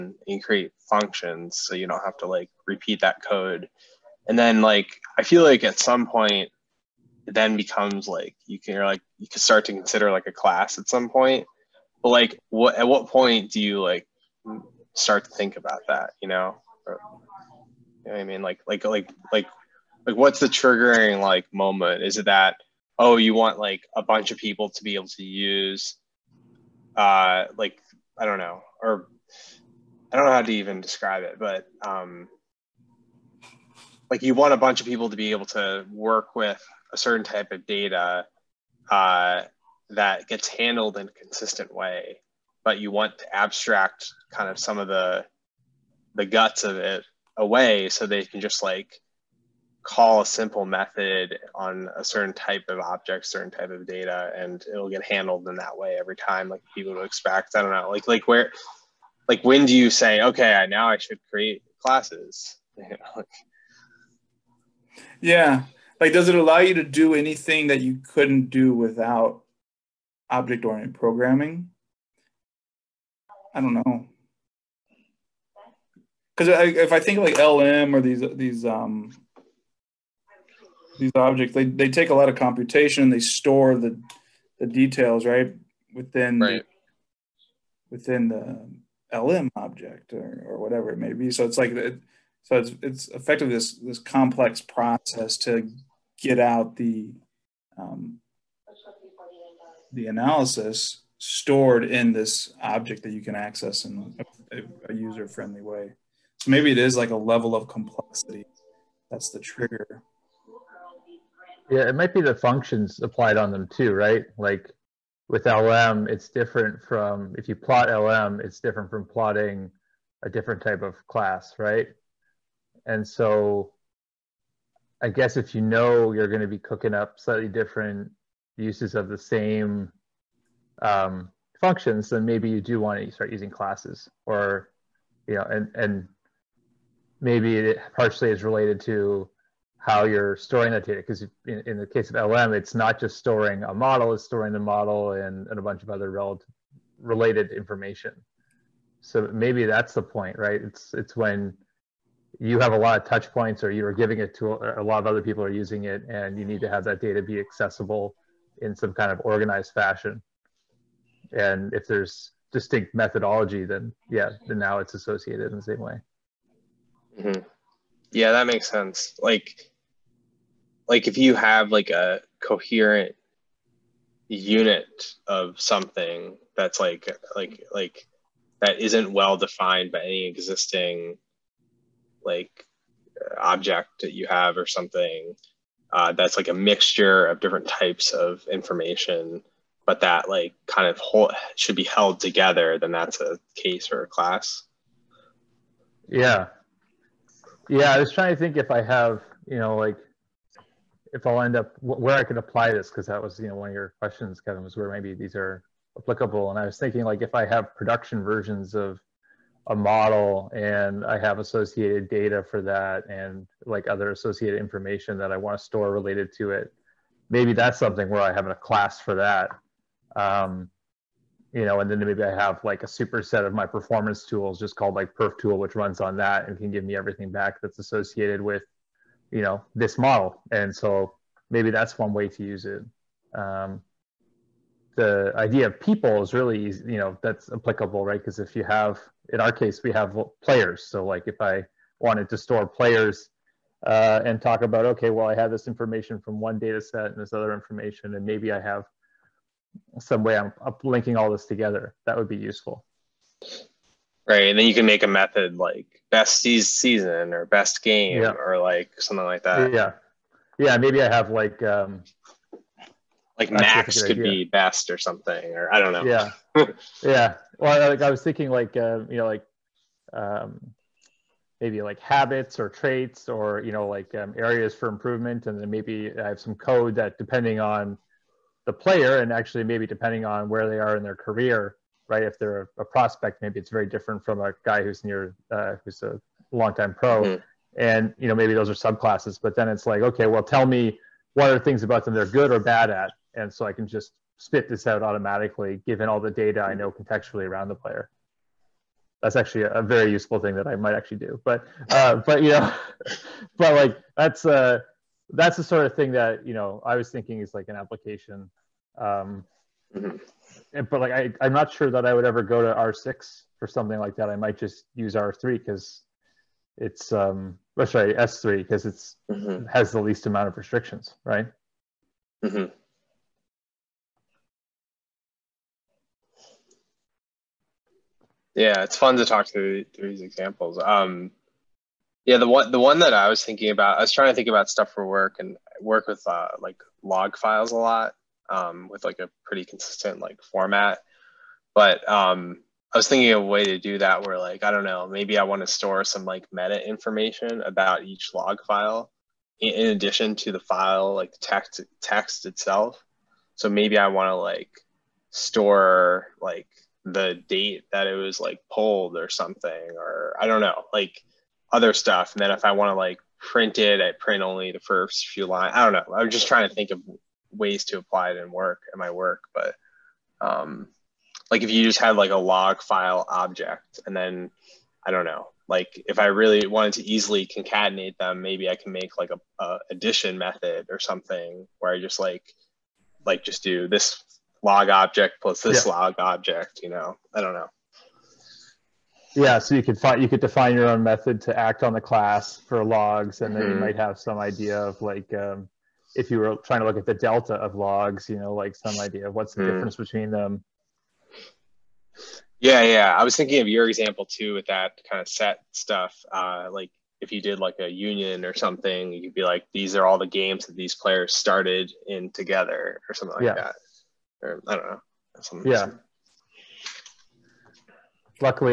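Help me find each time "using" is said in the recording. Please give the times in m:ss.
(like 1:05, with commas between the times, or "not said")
2:13, 2:35.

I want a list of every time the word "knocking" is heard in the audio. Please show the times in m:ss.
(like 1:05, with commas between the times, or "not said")
not said.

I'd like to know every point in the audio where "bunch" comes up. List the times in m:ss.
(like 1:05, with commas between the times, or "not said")
0:24, 0:34, 2:25.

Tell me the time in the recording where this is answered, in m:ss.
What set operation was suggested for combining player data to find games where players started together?
6:47.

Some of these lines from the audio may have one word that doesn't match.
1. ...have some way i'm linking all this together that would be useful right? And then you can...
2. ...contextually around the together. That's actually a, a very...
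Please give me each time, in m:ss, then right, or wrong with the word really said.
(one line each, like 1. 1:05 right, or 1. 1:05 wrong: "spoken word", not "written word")
1. 4:08 right
2. 4:56 wrong: "player", not "together".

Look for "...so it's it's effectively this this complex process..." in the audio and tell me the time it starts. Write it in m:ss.
1:32.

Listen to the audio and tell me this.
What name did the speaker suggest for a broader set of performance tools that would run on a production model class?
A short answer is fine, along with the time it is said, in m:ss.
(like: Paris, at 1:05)
perf tool, at 3:45.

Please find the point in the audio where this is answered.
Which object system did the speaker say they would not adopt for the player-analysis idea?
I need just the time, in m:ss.
5:12.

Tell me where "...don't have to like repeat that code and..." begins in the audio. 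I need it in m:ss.
0:01.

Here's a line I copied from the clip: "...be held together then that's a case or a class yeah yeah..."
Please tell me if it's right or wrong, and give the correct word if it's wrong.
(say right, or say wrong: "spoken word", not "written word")
right.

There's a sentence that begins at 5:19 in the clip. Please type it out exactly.
has the least amount of restrictions, right?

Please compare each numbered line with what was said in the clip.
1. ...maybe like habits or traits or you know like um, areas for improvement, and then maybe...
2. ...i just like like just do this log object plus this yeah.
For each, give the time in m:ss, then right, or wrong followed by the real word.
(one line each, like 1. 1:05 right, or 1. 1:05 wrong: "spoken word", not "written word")
1. 4:31 right
2. 6:21 right.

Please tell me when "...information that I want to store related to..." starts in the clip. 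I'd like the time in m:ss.
3:34.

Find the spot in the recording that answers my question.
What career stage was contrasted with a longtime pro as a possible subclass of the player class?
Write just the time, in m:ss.
4:42.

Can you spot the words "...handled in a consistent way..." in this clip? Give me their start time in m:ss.
0:40.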